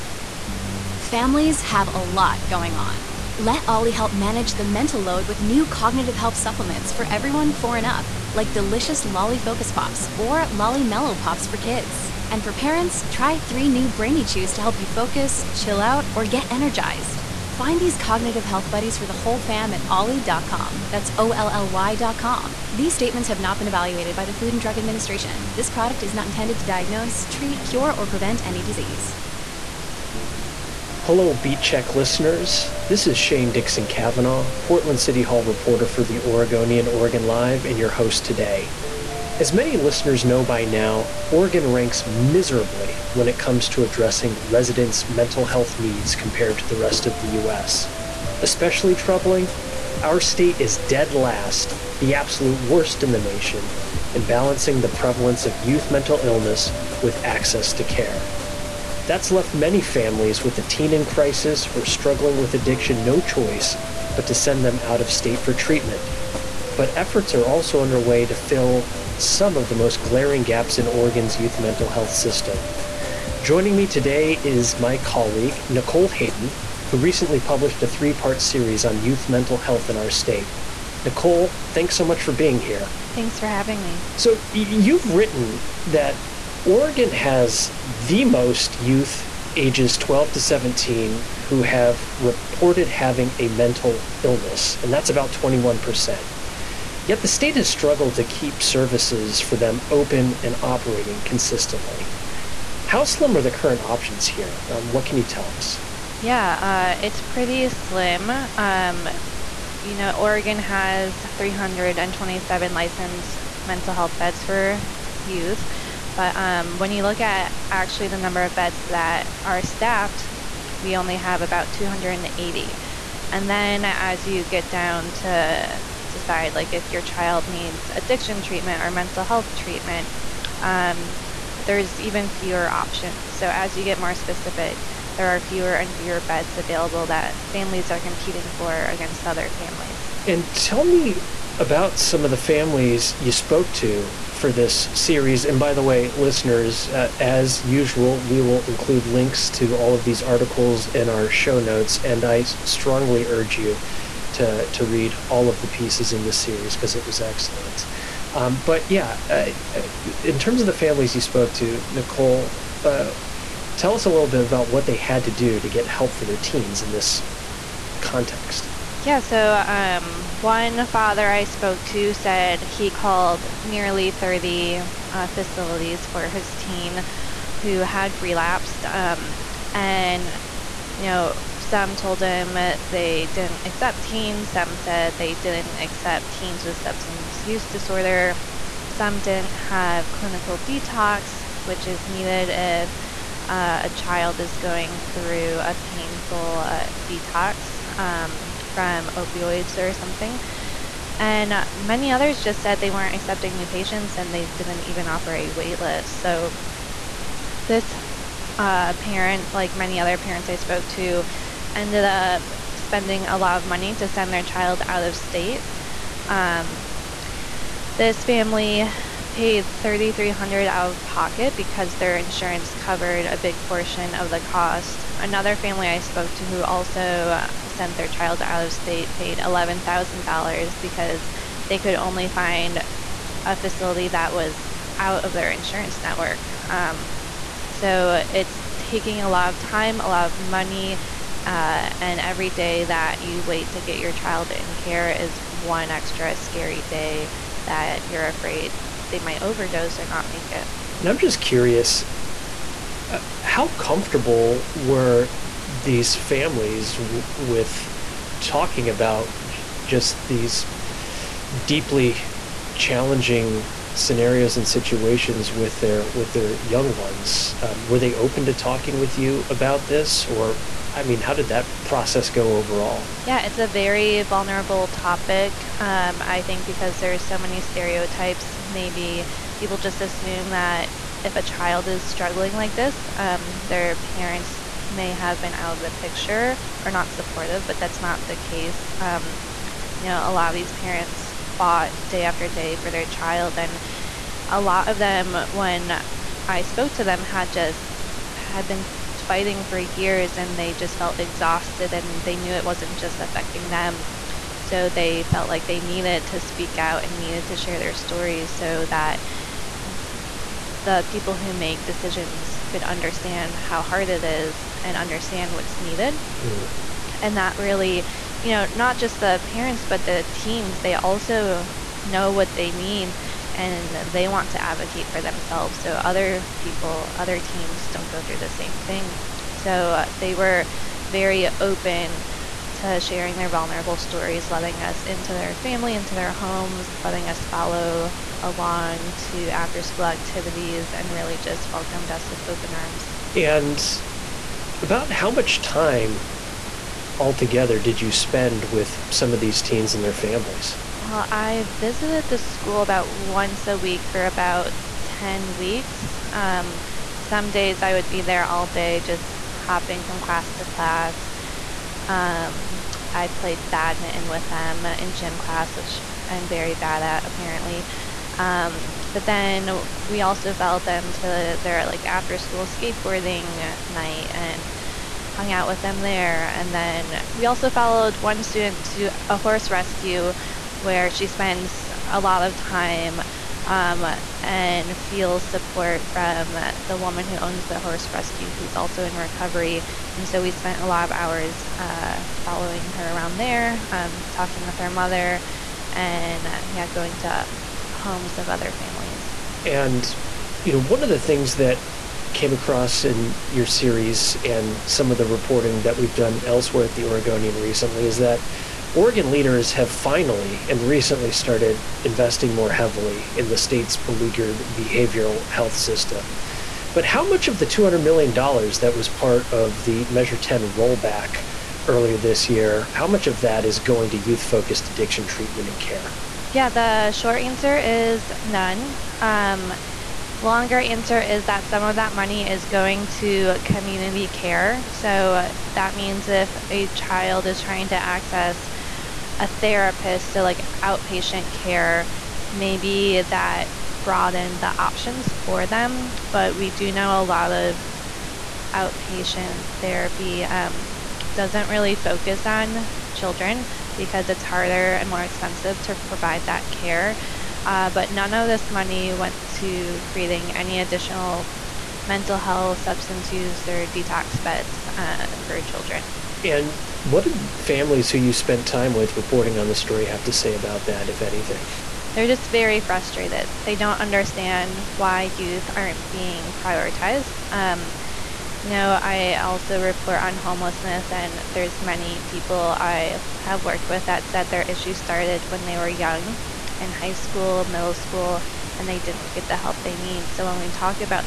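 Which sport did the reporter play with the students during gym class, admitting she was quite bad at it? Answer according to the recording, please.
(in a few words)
badminton.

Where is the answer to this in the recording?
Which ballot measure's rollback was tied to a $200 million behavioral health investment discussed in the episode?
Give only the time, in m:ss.
7:00.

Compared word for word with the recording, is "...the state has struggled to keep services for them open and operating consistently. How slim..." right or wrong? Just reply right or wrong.
right.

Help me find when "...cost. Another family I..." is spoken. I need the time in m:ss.
3:44.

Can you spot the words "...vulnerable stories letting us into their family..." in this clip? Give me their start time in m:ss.
5:33.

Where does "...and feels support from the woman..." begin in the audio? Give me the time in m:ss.
6:24.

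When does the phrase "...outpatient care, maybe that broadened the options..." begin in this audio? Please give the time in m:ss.
7:20.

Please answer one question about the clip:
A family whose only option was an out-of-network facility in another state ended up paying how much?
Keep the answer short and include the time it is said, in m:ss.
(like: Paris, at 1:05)
$11,000, at 3:49.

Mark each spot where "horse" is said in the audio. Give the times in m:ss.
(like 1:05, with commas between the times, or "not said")
6:19, 6:27.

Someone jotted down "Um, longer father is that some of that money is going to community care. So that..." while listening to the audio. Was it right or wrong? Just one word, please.
wrong.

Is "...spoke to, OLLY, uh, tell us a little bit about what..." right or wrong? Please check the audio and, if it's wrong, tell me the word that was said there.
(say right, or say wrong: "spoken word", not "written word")
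wrong: "Nicole", not "OLLY".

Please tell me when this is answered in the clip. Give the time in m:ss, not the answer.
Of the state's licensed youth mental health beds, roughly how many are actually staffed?
2:01.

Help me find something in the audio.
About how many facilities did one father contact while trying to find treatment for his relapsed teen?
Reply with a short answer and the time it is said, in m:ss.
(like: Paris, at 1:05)
nearly 30, at 2:53.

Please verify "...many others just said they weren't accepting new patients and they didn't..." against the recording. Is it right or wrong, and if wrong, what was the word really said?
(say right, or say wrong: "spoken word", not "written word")
right.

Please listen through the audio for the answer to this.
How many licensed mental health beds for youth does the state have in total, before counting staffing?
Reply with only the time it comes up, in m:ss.
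1:51.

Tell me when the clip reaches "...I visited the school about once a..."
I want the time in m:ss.
5:51.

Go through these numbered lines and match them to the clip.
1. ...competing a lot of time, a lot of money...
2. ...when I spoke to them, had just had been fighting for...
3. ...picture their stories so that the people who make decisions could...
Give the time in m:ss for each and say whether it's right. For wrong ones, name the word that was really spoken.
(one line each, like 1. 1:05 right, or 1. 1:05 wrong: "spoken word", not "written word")
1. 3:58 wrong: "taking", not "competing"
2. 4:55 right
3. 5:07 wrong: "share", not "picture".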